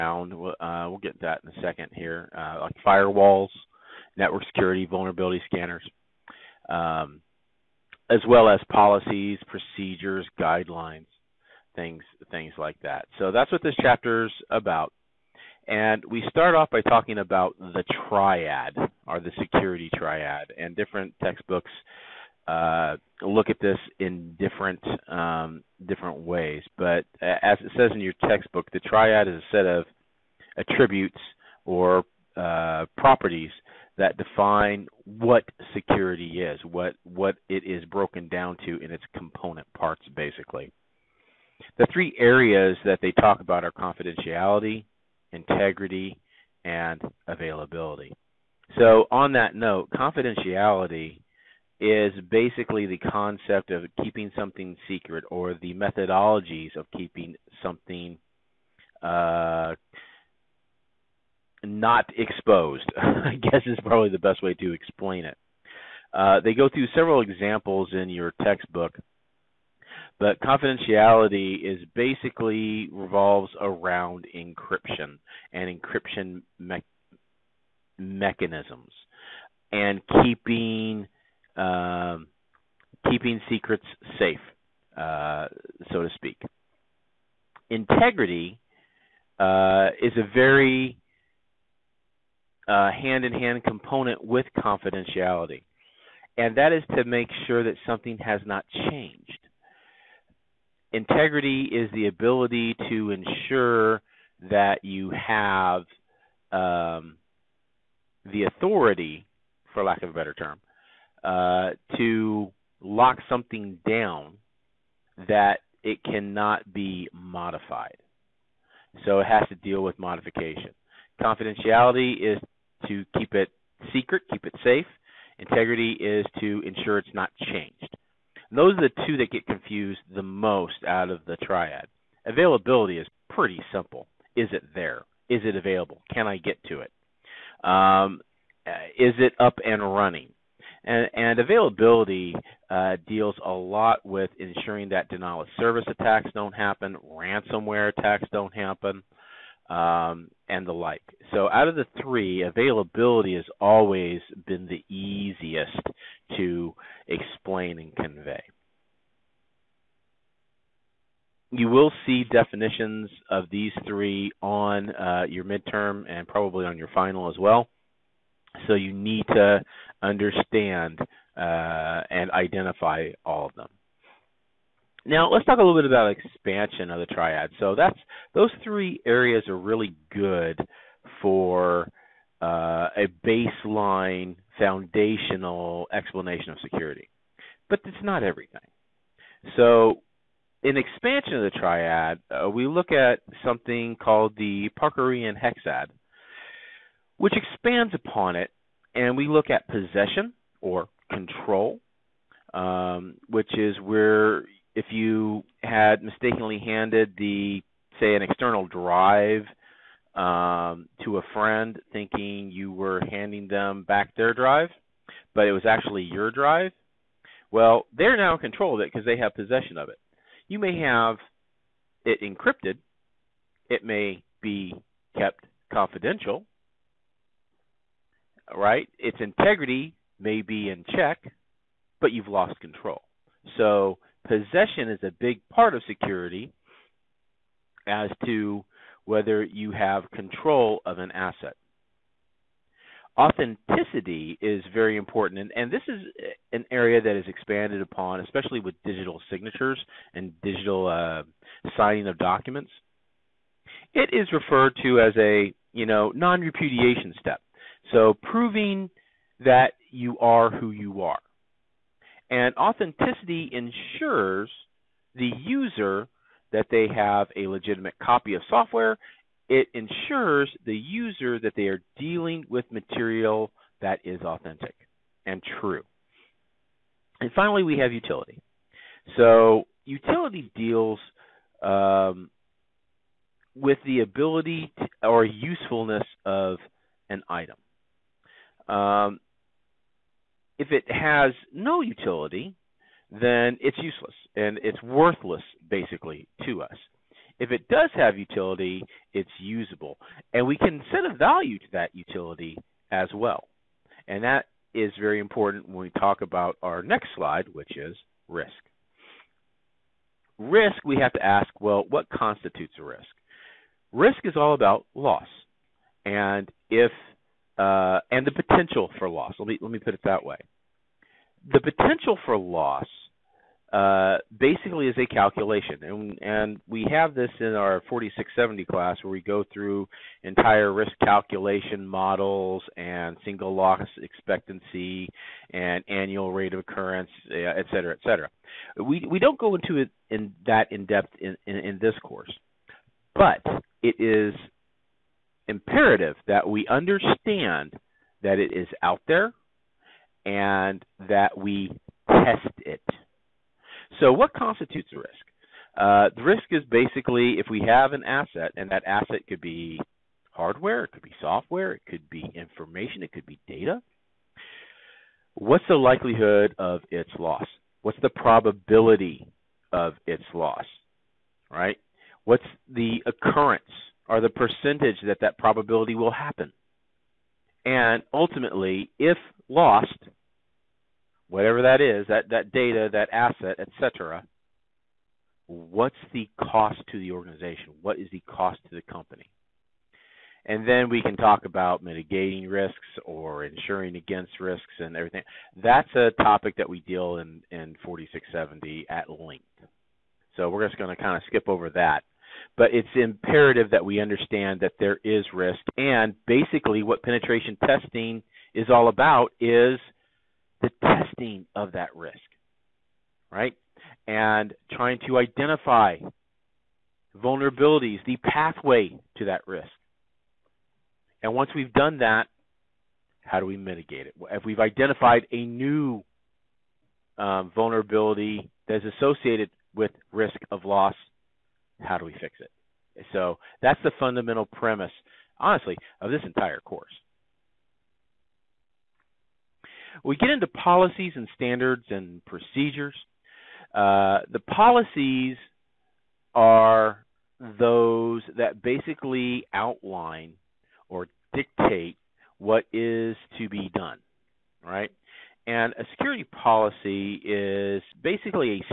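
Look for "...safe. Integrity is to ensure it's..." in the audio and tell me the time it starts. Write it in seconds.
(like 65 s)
124 s.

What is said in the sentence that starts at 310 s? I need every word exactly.
Risk, we have to ask well, what constitutes a risk?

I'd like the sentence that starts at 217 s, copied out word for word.
Well, they're now in control of it because they have possession of it.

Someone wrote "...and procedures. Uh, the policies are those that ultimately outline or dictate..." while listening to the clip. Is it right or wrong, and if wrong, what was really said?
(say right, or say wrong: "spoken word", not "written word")
wrong: "basically", not "ultimately".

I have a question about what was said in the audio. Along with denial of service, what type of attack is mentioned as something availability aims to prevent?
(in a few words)
Ransomware.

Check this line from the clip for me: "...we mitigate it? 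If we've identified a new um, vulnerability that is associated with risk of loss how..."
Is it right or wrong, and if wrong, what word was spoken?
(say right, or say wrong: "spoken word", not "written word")
right.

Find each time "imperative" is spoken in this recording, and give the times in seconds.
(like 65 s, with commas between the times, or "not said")
345 s, 402 s.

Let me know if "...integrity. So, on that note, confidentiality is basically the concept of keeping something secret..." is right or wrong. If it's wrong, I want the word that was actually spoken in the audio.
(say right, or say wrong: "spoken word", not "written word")
wrong: "availability", not "integrity".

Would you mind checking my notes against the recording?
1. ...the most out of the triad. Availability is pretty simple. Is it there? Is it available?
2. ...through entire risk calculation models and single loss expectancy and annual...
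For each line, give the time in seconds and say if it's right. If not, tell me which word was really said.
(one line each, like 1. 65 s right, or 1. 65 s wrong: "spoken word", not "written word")
1. 130 s right
2. 329 s right.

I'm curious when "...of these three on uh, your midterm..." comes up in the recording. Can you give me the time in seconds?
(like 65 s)
163 s.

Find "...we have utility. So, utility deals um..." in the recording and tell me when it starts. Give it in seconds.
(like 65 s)
277 s.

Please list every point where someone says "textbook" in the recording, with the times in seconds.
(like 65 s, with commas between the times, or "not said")
21 s, 28 s, 68 s.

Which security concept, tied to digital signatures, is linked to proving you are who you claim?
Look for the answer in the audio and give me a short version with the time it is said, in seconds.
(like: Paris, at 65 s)
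Non-repudiation, at 256 s.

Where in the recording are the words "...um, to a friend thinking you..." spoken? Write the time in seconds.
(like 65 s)
210 s.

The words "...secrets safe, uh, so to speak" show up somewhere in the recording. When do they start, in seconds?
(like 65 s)
83 s.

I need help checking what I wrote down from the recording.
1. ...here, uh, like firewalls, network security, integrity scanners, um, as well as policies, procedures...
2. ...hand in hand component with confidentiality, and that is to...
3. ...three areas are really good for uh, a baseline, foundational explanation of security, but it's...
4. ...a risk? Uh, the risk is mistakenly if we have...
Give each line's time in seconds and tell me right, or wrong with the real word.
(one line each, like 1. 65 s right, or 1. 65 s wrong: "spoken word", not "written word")
1. 1 s wrong: "vulnerability", not "integrity"
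2. 92 s right
3. 178 s right
4. 354 s wrong: "basically", not "mistakenly".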